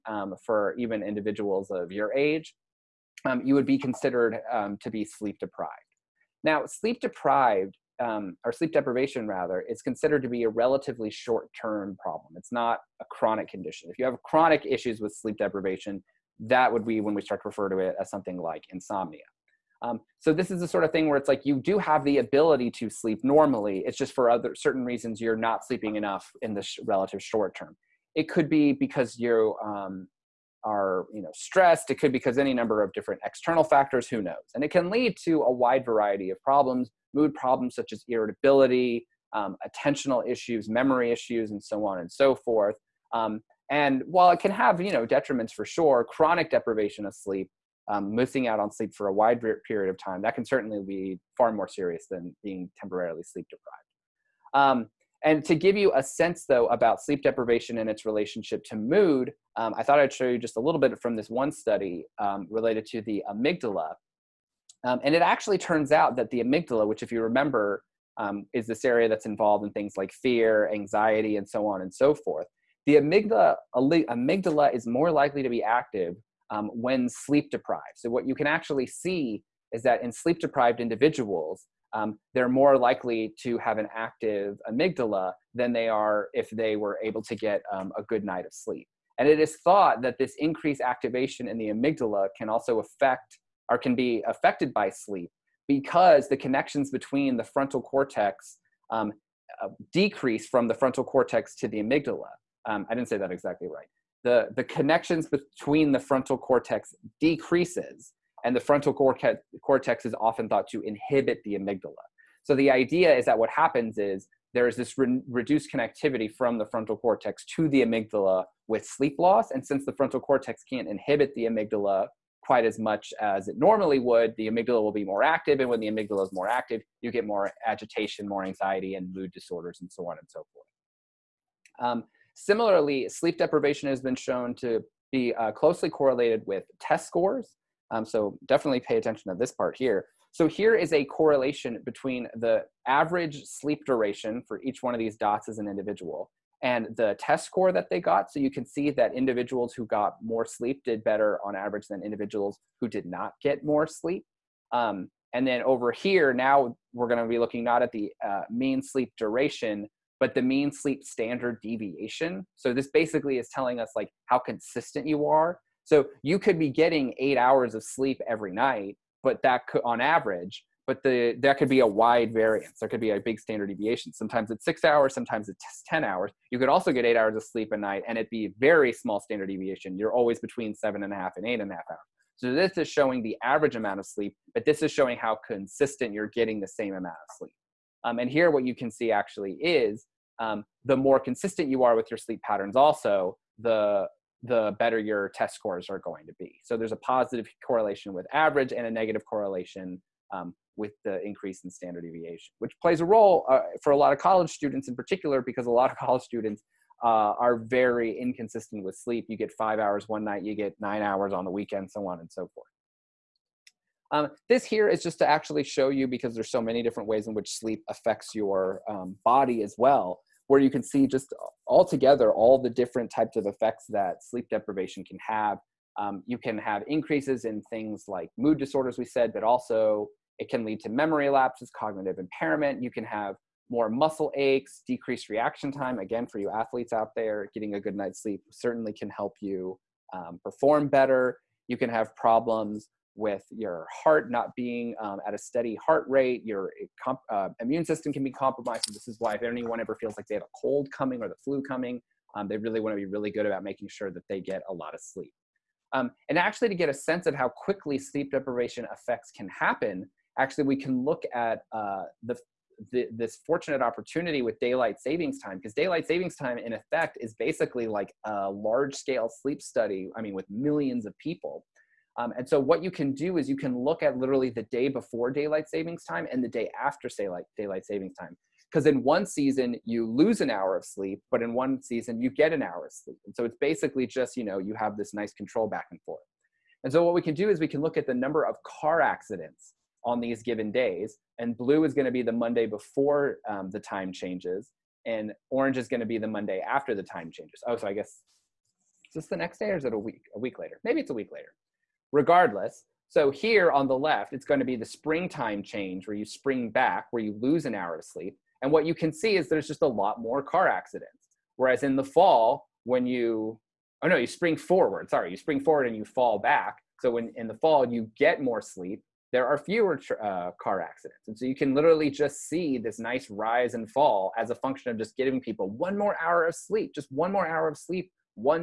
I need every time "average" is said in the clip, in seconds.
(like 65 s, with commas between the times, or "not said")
142 s, 151 s, 170 s, 183 s, 198 s.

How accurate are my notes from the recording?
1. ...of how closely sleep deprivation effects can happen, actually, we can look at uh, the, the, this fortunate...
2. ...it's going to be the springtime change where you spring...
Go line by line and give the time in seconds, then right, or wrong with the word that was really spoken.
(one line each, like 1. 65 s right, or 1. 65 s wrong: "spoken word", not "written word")
1. 257 s wrong: "quickly", not "closely"
2. 304 s right.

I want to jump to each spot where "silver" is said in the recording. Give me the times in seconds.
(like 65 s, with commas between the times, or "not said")
not said.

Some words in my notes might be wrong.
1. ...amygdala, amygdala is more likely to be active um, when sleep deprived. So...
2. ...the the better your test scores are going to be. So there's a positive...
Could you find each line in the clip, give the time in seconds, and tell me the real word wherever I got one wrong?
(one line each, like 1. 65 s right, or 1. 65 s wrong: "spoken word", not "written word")
1. 72 s right
2. 193 s right.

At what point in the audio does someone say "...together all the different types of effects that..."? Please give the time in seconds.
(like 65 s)
221 s.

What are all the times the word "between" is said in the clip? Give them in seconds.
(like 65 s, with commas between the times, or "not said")
96 s, 105 s, 141 s, 180 s.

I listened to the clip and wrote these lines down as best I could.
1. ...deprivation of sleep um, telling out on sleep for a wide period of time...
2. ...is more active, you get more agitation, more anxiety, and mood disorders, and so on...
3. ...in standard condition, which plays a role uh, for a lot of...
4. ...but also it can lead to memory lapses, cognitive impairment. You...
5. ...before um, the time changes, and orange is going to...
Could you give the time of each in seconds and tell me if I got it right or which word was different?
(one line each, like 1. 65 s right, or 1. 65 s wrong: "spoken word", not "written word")
1. 46 s wrong: "missing", not "telling"
2. 126 s right
3. 201 s wrong: "deviation", not "condition"
4. 229 s right
5. 292 s right.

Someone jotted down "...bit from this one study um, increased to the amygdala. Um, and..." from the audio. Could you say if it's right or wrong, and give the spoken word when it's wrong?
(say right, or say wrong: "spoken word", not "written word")
wrong: "related", not "increased".